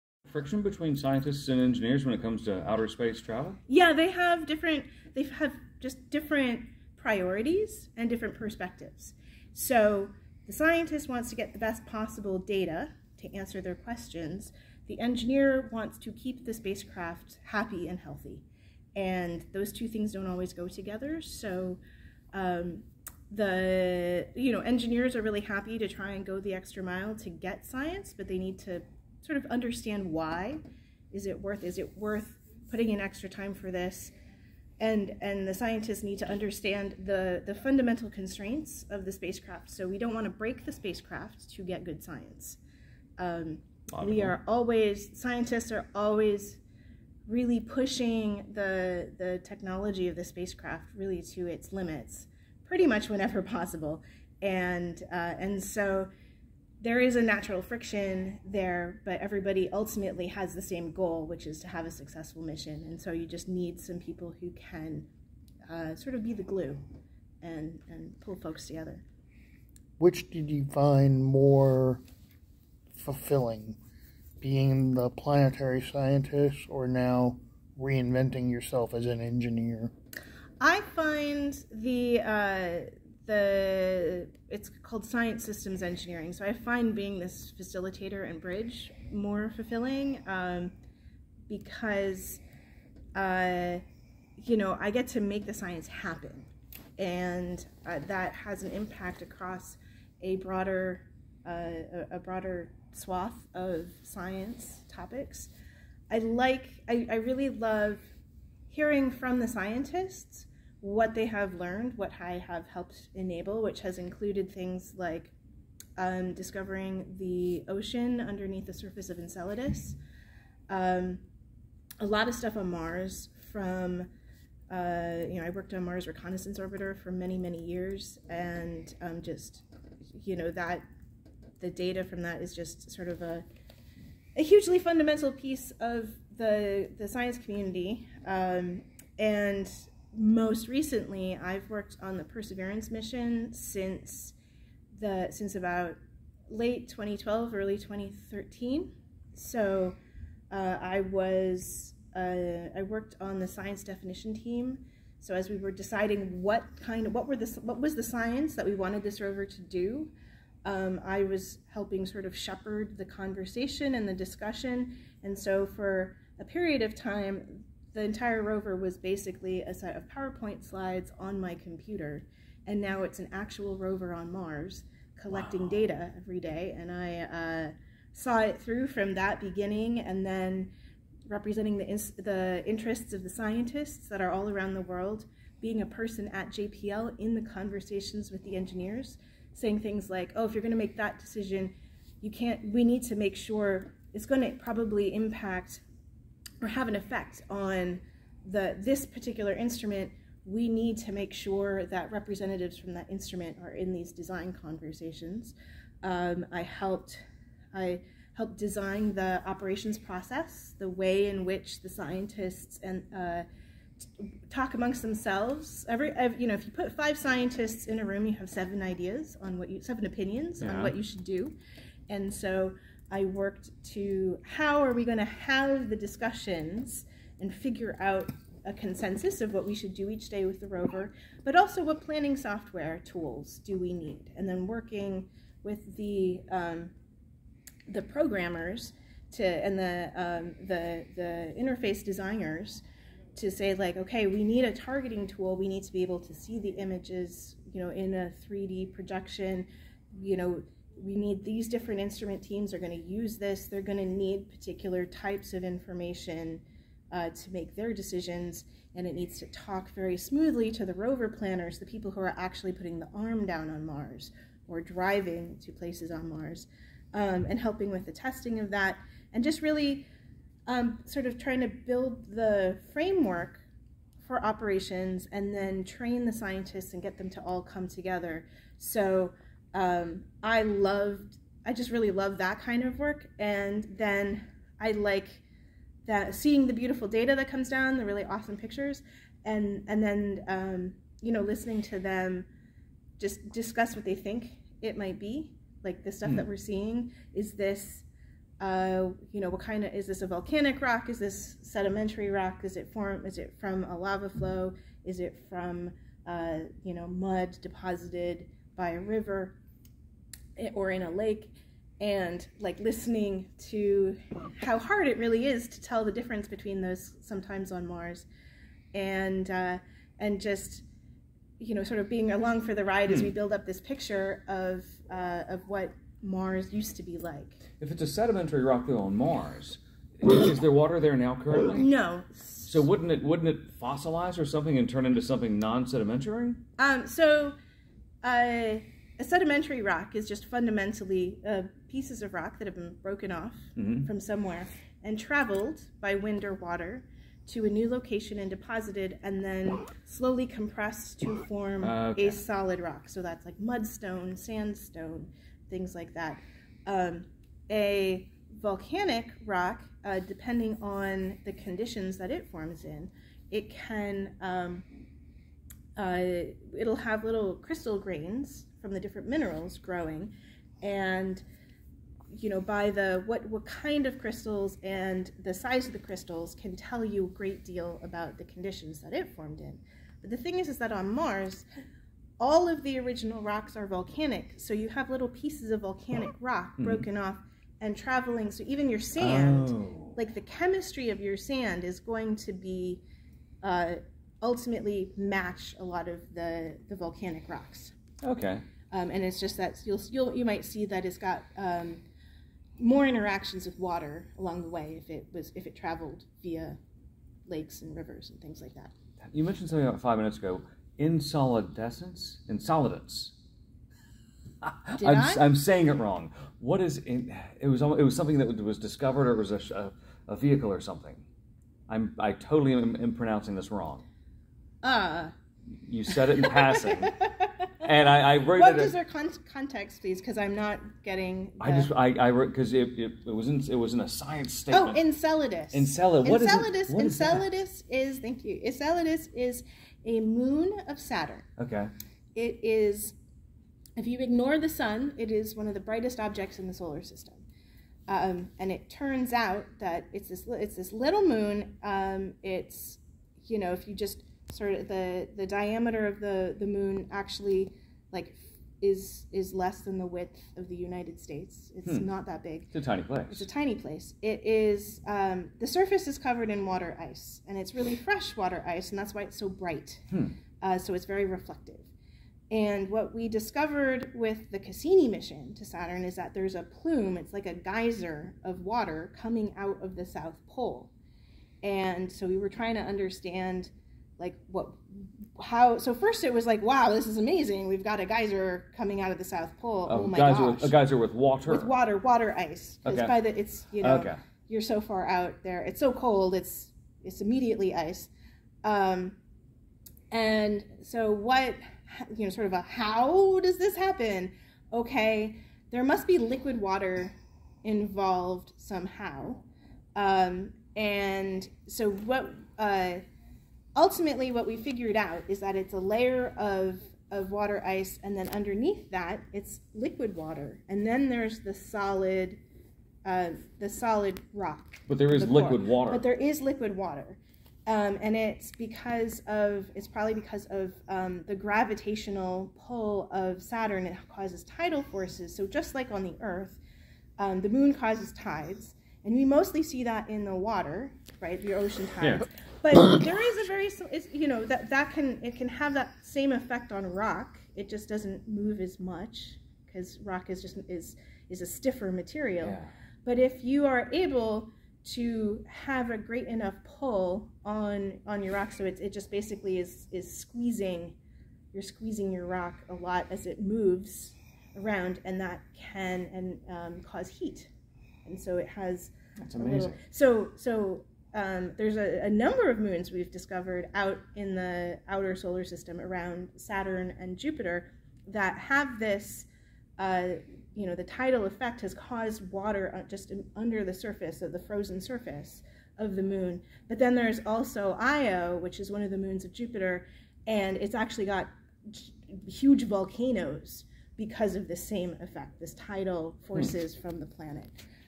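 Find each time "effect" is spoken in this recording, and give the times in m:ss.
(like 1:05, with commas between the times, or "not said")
3:16, 9:06, 9:41, 9:55.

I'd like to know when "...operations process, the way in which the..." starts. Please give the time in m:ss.
3:29.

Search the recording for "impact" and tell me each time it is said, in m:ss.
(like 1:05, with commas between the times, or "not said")
1:38, 3:15.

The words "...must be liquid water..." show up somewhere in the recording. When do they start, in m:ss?
8:25.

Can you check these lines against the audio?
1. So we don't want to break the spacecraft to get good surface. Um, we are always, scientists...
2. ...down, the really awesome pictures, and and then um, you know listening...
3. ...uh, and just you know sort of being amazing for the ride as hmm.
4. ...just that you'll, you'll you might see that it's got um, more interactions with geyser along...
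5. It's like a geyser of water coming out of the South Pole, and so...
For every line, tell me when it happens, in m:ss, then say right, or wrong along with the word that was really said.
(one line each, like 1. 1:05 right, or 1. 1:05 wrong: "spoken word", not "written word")
1. 0:39 wrong: "science", not "surface"
2. 4:47 right
3. 5:19 wrong: "along", not "amazing"
4. 6:39 wrong: "water", not "geyser"
5. 7:57 right.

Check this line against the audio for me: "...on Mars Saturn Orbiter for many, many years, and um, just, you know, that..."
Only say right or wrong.
wrong.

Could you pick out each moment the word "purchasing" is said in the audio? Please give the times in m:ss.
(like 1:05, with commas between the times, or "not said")
not said.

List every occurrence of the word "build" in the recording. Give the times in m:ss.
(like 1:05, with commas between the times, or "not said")
4:31, 5:23.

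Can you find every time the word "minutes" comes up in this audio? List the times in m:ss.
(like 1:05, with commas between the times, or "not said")
6:50.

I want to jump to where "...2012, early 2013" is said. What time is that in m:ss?
2:26.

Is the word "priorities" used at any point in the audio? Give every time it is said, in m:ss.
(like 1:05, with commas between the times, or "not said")
0:06.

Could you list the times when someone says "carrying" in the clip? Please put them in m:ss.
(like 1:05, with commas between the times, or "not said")
not said.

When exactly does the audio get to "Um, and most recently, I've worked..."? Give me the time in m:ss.
2:18.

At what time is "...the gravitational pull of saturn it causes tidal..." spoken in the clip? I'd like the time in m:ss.
8:51.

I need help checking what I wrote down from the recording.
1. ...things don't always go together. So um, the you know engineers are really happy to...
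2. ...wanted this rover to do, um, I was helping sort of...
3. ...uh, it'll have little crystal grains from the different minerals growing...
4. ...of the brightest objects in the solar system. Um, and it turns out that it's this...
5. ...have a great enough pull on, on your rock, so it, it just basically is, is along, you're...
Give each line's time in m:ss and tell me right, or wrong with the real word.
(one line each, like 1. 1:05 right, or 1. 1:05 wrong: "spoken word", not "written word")
1. 0:19 right
2. 2:38 right
3. 6:06 right
4. 7:25 right
5. 9:15 wrong: "squeezing", not "along".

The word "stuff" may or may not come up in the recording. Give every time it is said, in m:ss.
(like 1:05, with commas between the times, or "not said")
2:02, 4:56.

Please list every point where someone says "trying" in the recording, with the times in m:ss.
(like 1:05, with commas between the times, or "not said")
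4:31, 8:02.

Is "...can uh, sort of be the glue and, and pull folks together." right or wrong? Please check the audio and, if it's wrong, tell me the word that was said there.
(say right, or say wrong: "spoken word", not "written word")
right.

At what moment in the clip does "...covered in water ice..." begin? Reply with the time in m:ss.
7:46.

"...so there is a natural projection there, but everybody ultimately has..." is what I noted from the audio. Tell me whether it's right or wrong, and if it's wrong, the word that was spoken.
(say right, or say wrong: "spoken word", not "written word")
wrong: "friction", not "projection".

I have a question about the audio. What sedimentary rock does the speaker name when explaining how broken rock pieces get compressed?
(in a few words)
mudstone.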